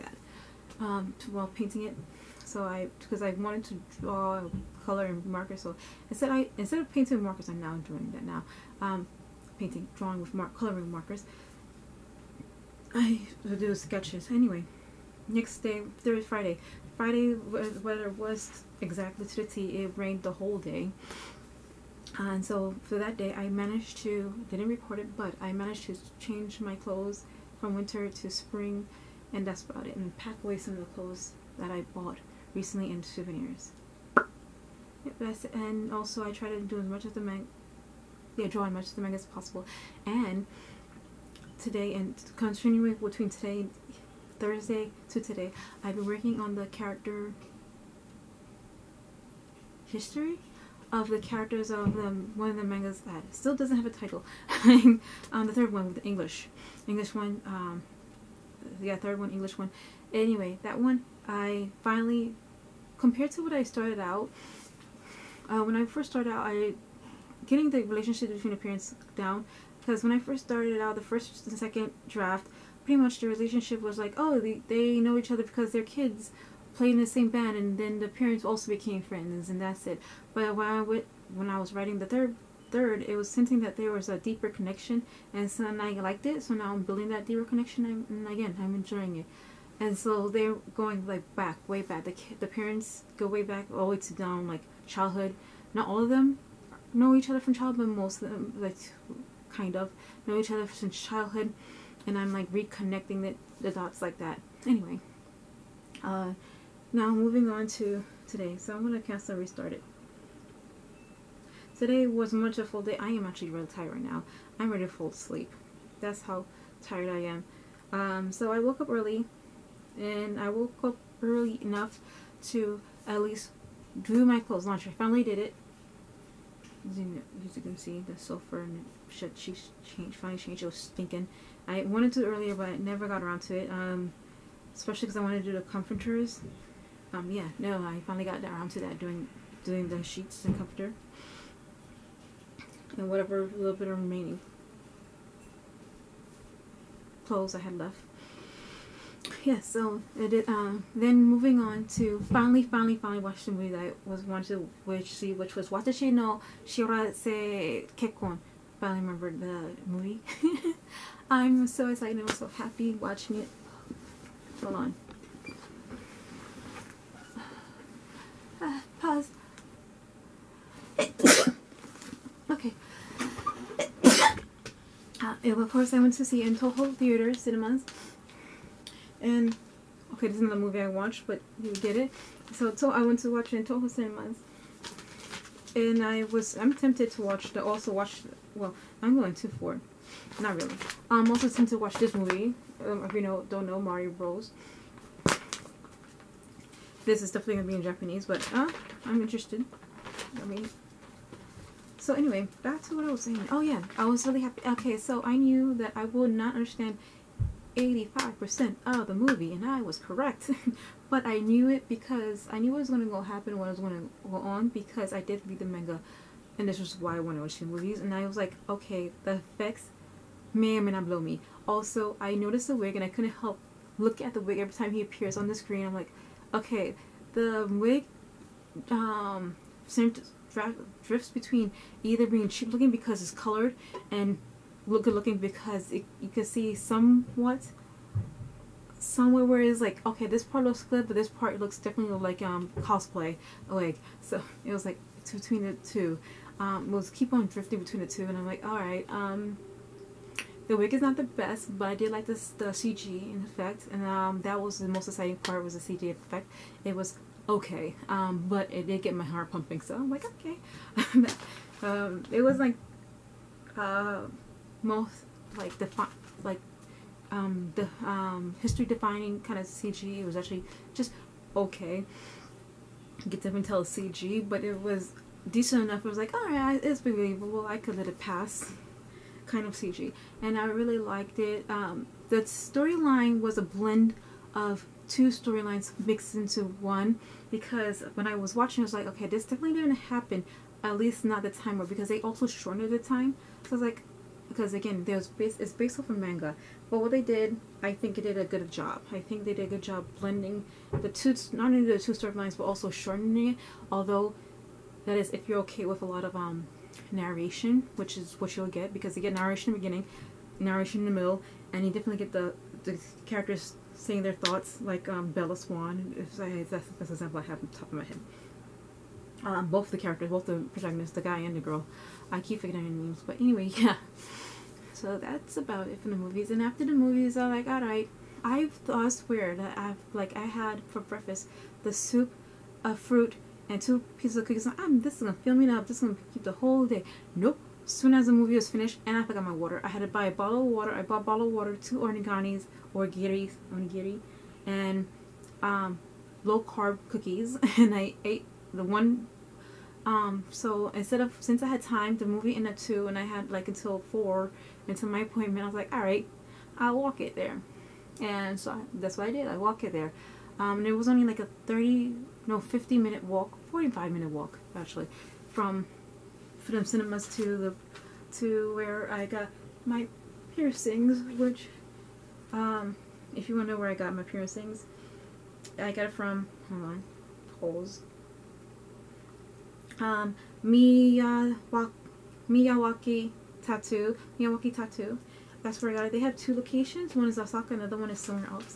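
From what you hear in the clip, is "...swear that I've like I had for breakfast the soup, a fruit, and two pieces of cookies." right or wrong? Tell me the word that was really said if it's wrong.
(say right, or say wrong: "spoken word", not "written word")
right.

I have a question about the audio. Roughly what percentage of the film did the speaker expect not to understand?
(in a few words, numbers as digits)
85%.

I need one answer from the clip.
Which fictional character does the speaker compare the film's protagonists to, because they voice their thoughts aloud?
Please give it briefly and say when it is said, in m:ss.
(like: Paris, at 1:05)
Bella Swan, at 5:15.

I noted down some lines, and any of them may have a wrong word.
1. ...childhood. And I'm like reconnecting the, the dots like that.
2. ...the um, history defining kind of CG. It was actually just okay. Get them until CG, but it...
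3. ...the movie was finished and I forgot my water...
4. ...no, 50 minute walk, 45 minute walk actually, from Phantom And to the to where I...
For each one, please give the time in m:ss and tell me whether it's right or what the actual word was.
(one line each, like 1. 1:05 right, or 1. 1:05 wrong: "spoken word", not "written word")
1. 1:41 right
2. 4:27 right
3. 5:38 right
4. 6:02 wrong: "Cinemas", not "And".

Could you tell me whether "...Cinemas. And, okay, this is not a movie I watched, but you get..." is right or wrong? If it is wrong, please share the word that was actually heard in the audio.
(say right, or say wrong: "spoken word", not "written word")
right.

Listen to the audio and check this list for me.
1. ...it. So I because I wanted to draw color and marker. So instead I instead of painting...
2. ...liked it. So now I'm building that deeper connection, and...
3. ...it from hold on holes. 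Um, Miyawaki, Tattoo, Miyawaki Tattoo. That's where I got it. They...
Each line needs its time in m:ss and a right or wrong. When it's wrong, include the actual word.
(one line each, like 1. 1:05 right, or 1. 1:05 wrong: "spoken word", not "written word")
1. 0:01 right
2. 1:25 right
3. 6:16 right.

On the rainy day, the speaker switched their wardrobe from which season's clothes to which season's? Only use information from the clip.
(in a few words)
winter to spring.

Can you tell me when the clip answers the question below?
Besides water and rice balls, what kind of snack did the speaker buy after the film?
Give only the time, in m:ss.
5:46.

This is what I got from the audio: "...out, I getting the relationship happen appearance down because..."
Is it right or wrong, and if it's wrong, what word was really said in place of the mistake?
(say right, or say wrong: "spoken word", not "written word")
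wrong: "between", not "happen".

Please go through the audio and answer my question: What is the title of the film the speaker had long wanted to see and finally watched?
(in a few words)
Watashi no Shiawase Kekkon.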